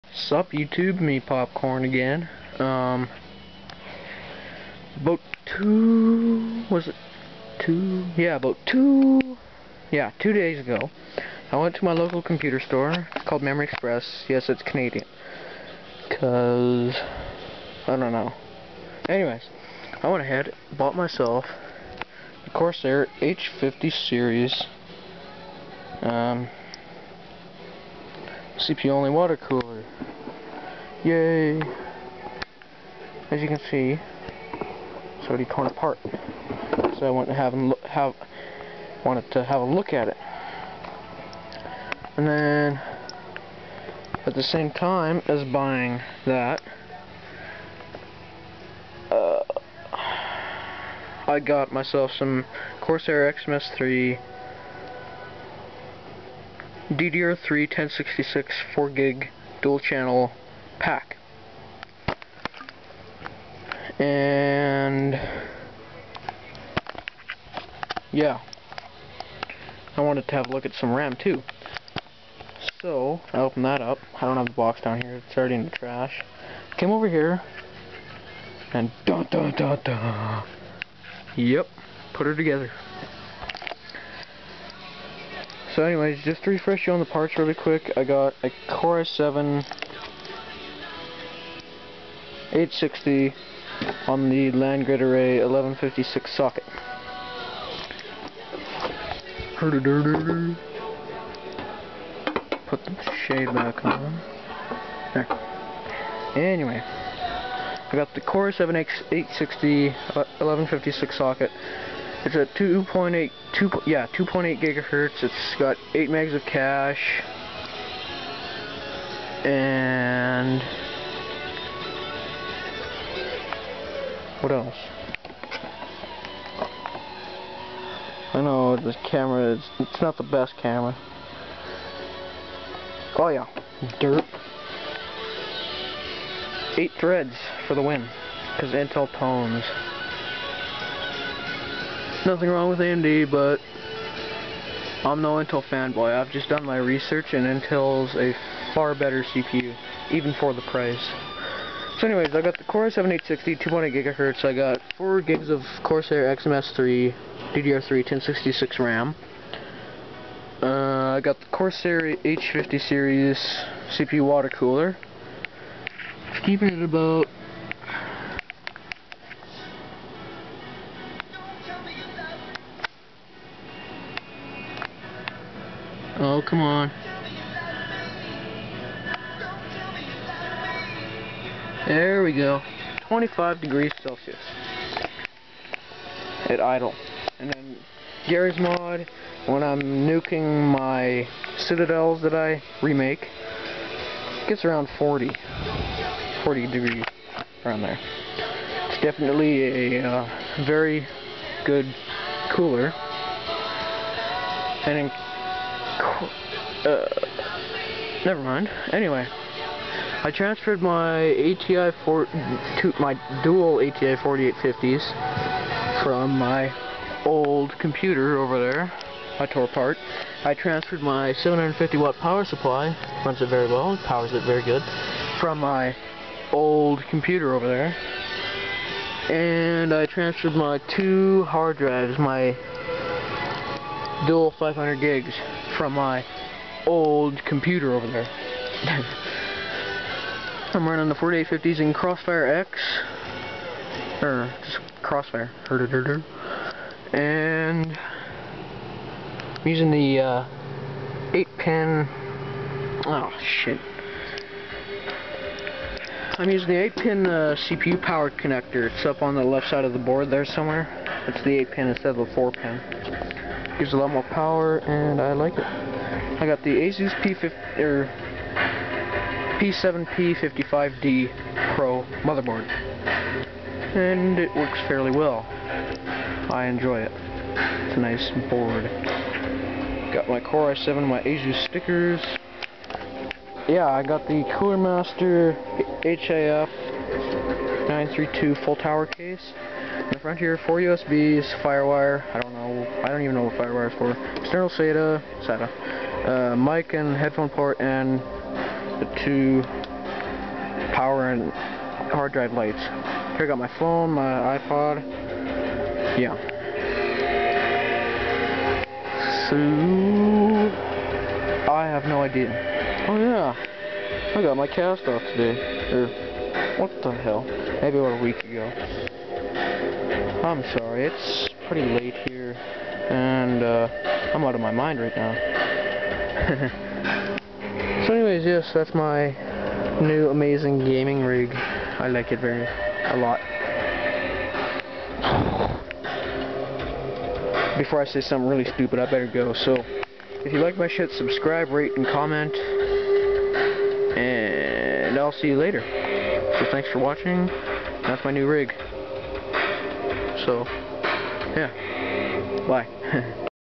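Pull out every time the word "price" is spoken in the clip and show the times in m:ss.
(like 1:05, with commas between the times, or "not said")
2:30.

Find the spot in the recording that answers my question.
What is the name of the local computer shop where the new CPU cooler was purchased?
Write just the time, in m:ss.
0:13.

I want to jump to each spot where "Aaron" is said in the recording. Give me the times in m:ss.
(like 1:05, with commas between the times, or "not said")
not said.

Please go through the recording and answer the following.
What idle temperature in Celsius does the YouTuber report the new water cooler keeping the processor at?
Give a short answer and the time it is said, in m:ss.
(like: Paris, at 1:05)
25 degrees, at 3:03.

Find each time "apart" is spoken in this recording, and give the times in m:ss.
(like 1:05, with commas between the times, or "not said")
0:35, 3:39.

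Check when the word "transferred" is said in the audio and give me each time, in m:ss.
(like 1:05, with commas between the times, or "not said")
3:30, 3:40, 3:50.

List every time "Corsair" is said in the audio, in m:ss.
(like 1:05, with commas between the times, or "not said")
0:22, 0:52, 2:35, 2:41.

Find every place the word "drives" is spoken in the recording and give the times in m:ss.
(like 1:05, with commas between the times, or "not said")
3:51, 5:02.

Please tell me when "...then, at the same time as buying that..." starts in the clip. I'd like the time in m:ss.
0:42.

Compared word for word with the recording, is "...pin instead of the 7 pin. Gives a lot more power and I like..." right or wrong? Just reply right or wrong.
wrong.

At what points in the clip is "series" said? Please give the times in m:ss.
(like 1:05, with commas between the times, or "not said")
0:23, 2:42.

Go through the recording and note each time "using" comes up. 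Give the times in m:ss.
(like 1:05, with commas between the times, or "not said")
4:09, 4:16.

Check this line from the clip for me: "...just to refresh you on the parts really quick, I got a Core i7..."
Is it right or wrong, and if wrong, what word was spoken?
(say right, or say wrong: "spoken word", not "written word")
right.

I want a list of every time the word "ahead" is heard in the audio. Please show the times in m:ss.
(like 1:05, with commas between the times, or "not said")
0:20.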